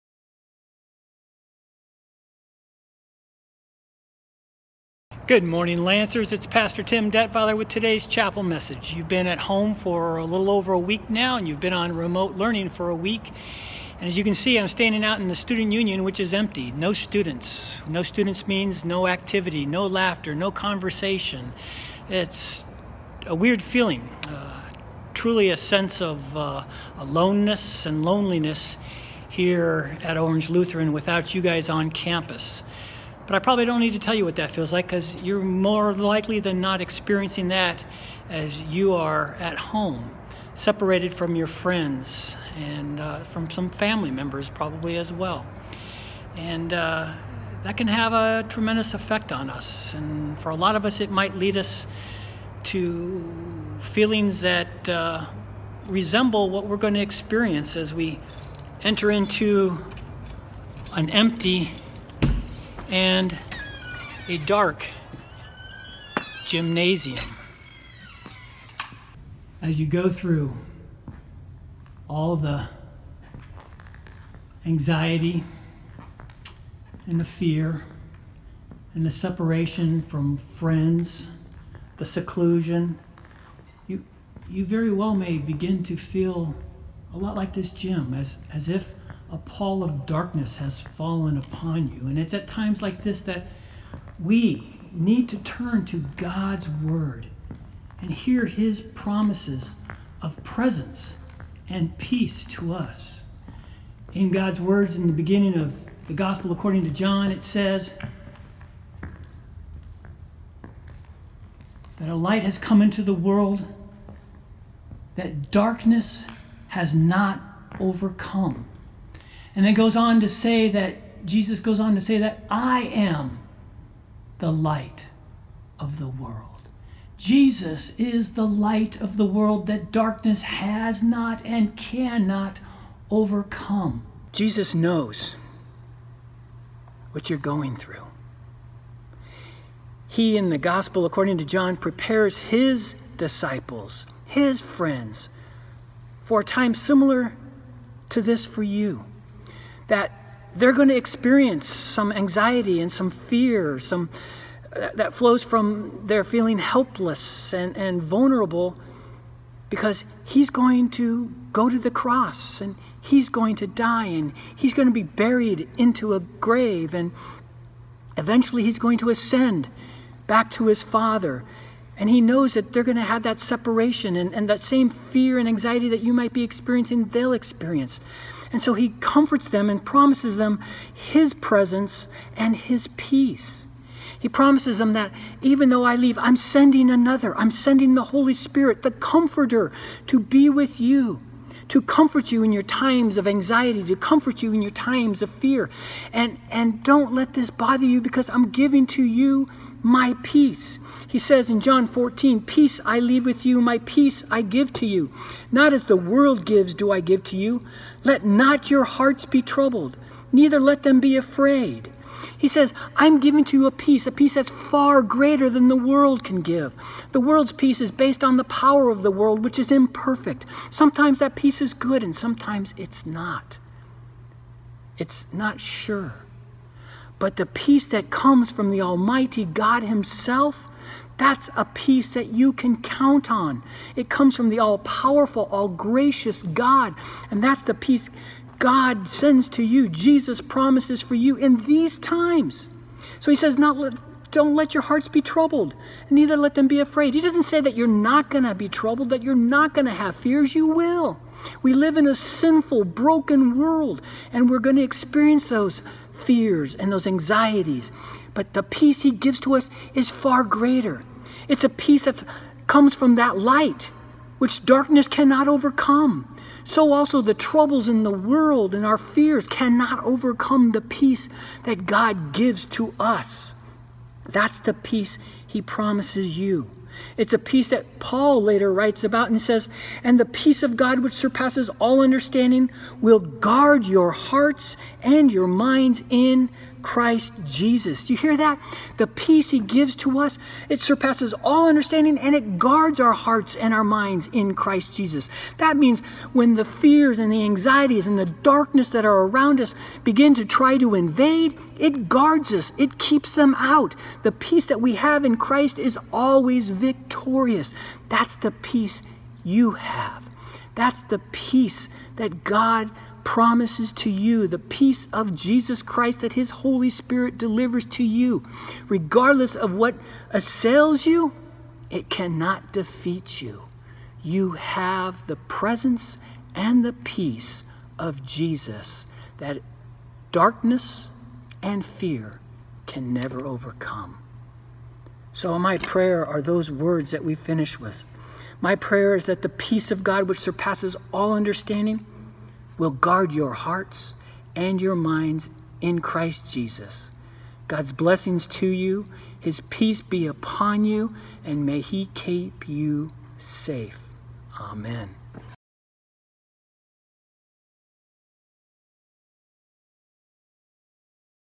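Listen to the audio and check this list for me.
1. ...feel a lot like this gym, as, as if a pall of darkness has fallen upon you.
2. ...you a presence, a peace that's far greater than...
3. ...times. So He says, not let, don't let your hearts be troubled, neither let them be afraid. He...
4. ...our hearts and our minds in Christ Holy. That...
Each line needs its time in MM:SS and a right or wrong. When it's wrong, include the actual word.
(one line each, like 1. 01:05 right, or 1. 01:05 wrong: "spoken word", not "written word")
1. 01:25 right
2. 03:33 wrong: "peace", not "presence"
3. 04:01 right
4. 04:52 wrong: "Jesus", not "Holy".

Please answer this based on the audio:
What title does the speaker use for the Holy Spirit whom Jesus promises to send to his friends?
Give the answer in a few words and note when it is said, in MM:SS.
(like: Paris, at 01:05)
The Comforter, at 03:08.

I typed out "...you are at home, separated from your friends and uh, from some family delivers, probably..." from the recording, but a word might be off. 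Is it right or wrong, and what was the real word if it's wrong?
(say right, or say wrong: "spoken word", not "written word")
wrong: "members", not "delivers".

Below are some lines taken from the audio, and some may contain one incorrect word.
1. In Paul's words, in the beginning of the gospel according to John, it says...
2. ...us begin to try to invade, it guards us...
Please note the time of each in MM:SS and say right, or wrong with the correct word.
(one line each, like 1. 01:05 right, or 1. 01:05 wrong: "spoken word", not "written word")
1. 01:44 wrong: "God", not "Paul"
2. 04:59 right.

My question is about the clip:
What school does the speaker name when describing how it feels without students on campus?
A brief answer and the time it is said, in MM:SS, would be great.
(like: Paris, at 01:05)
Orange Lutheran, at 00:30.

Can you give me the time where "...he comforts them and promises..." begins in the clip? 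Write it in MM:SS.
02:58.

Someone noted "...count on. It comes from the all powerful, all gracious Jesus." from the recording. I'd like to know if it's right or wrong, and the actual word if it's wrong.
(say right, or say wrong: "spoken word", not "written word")
wrong: "God", not "Jesus".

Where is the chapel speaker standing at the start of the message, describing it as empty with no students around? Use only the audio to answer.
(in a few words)
The student union.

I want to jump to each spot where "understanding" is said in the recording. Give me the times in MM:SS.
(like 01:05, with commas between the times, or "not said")
04:42, 04:51, 05:41.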